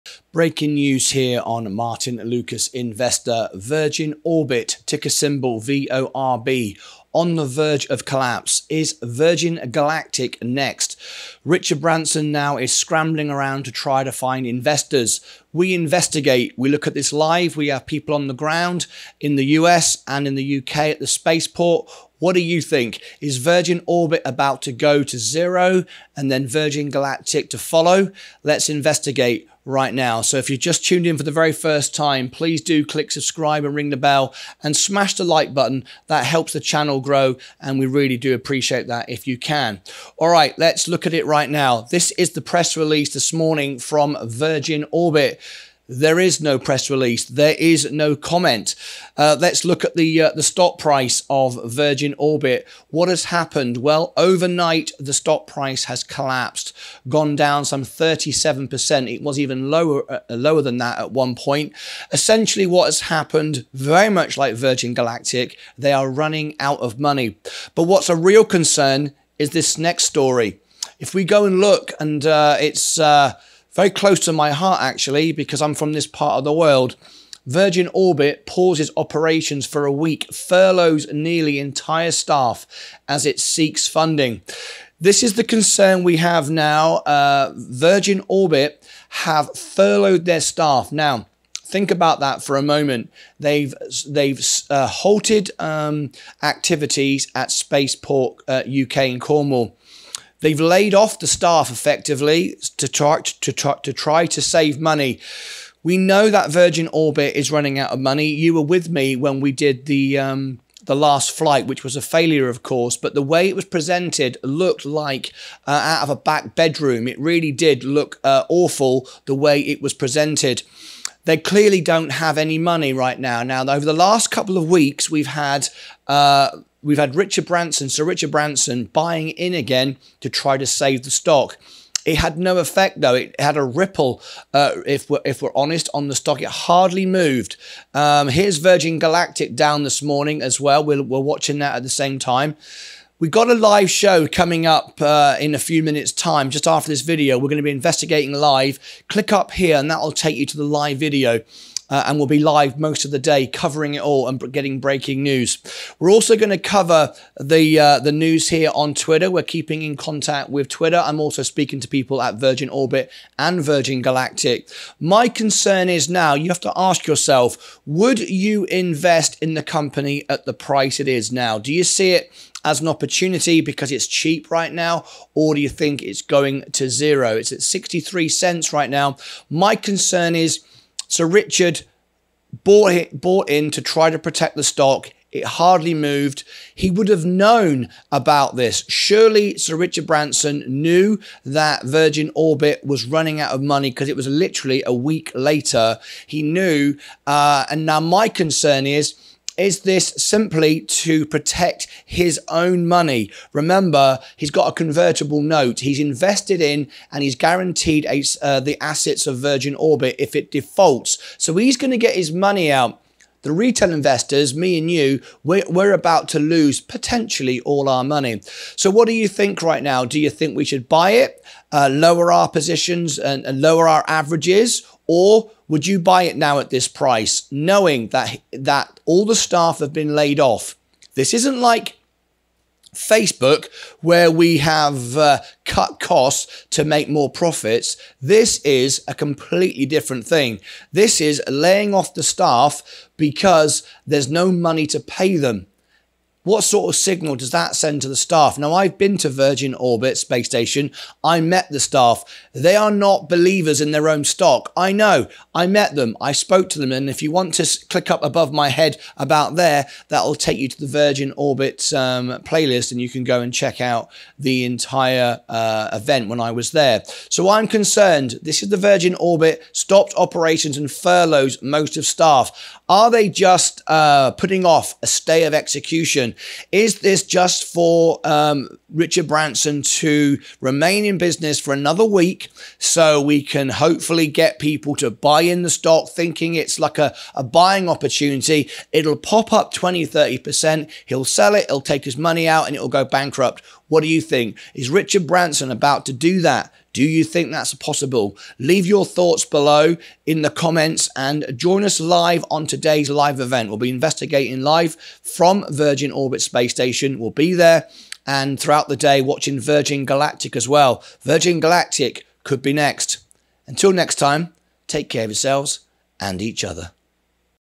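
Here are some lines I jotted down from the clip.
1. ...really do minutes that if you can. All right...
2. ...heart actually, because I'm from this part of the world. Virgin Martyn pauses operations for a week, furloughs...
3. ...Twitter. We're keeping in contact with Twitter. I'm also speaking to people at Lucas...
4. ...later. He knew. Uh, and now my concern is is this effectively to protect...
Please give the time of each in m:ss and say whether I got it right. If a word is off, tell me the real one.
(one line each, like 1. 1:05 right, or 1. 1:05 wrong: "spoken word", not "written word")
1. 0:37 wrong: "appreciate", not "minutes"
2. 1:14 wrong: "Orbit", not "Martyn"
3. 2:38 wrong: "Virgin", not "Lucas"
4. 3:15 wrong: "simply", not "effectively".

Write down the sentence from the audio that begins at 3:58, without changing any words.
This is a completely different thing.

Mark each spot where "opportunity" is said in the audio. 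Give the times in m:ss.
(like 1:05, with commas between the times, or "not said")
2:52, 4:47.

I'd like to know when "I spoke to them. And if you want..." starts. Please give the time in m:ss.
4:16.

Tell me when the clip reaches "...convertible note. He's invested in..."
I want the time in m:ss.
3:24.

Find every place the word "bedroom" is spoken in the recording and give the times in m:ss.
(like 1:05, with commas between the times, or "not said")
1:56.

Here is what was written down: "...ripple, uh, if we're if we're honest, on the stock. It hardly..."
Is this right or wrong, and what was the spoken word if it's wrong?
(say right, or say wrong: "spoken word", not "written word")
right.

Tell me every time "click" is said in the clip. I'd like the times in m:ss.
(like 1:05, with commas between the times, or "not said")
0:32, 2:29, 4:17.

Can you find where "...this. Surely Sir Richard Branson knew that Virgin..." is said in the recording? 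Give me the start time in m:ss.
3:08.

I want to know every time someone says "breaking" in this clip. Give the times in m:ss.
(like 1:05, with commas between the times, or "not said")
0:00, 2:34.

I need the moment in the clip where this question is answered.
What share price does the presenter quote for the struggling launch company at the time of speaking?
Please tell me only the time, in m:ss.
2:57.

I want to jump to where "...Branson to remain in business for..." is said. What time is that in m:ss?
4:39.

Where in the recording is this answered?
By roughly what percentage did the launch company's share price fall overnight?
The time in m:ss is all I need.
0:57.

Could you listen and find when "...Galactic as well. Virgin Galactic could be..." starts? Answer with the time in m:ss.
5:10.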